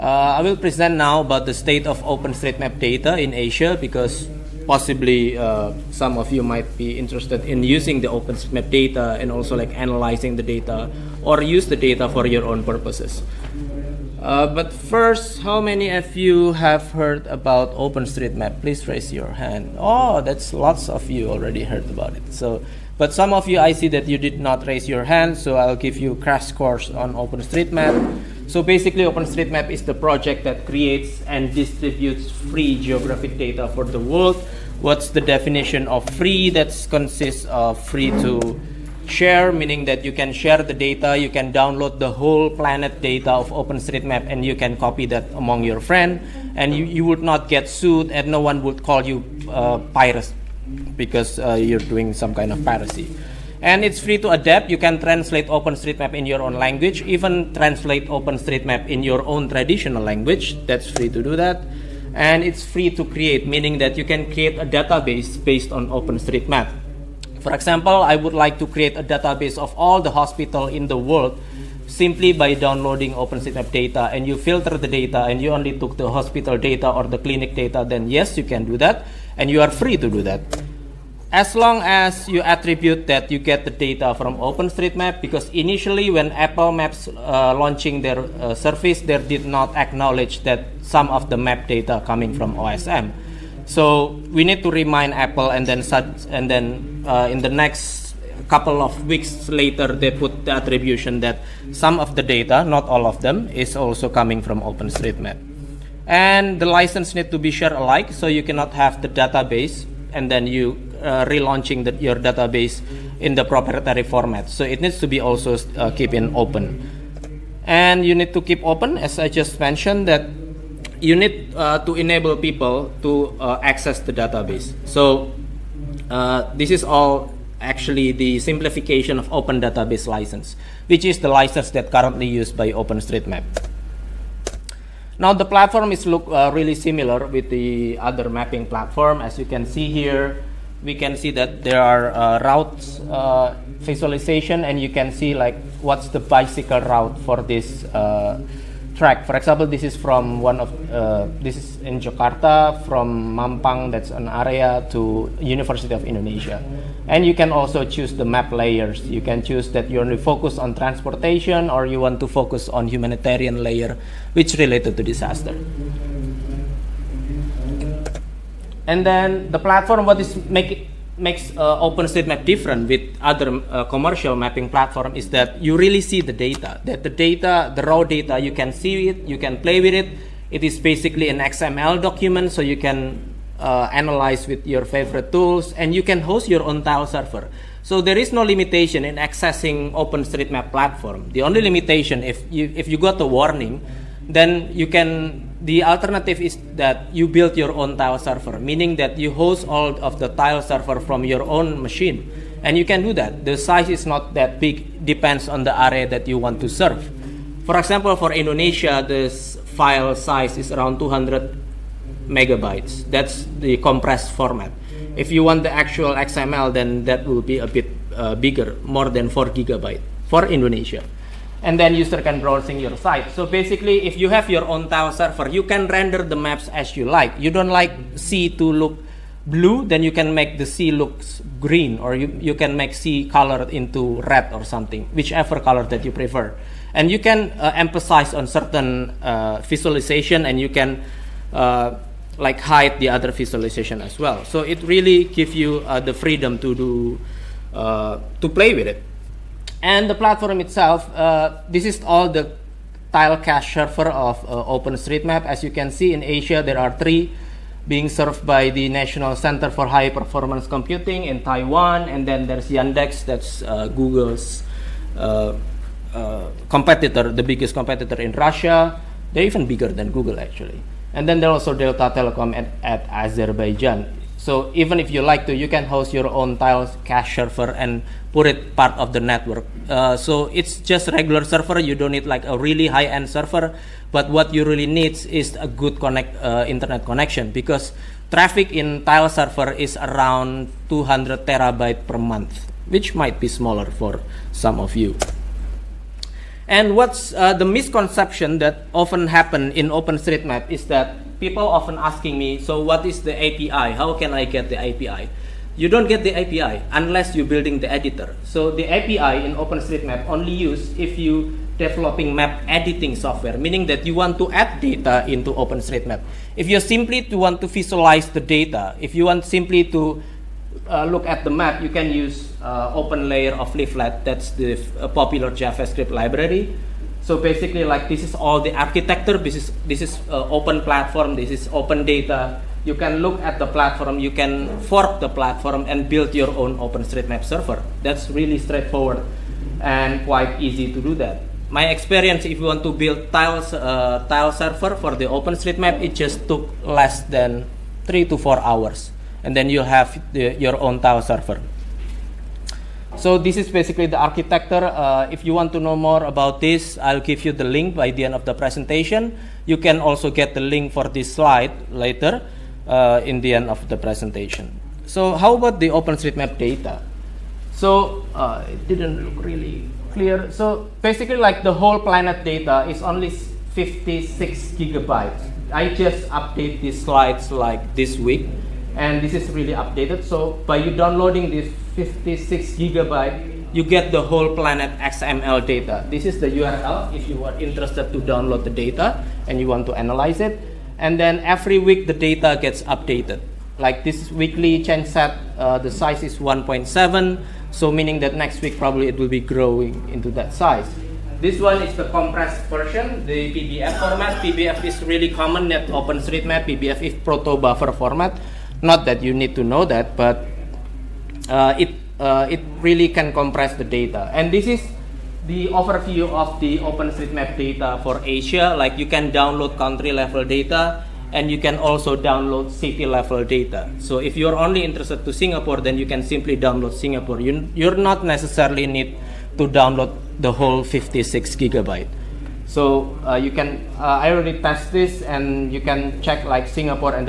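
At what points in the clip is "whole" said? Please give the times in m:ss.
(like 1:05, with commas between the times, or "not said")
0:42, 6:11, 6:24, 7:10.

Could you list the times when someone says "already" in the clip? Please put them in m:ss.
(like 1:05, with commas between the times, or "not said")
0:21, 7:14.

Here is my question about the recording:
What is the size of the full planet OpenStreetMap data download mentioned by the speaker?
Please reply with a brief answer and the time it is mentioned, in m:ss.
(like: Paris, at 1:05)
56 gigabytes, at 6:13.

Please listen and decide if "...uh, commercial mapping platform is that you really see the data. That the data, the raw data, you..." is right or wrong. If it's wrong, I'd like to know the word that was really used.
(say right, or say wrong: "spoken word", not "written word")
right.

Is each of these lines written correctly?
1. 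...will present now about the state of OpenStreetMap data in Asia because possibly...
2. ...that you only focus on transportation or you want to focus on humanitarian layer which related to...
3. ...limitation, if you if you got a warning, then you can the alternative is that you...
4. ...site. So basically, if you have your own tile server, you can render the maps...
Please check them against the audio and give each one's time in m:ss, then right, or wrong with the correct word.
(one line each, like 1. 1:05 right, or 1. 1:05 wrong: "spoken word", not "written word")
1. 0:00 right
2. 2:39 right
3. 3:11 right
4. 3:42 right.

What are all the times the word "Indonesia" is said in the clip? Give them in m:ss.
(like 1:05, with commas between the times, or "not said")
2:36, 3:28, 3:40.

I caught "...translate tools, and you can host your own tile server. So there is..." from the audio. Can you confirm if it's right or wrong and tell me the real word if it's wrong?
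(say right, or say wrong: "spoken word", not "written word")
wrong: "favorite", not "translate".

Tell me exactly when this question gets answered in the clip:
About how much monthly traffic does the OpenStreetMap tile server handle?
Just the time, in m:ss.
4:50.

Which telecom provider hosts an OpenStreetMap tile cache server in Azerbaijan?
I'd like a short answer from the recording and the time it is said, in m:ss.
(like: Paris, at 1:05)
Delta Telecom, at 4:31.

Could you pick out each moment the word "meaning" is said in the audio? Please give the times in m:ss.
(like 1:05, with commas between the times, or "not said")
0:39, 1:03, 3:18, 5:13, 6:37.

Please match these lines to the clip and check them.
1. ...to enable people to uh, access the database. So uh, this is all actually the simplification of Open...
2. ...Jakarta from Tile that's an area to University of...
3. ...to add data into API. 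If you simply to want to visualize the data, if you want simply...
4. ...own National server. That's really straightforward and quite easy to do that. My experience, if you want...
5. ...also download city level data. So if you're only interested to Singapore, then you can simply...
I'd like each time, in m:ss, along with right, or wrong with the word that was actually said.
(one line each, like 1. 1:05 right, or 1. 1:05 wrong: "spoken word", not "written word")
1. 2:01 right
2. 2:31 wrong: "Mampang", not "Tile"
3. 5:14 wrong: "OpenStreetMap", not "API"
4. 5:36 wrong: "OpenStreetMap", not "National"
5. 7:01 right.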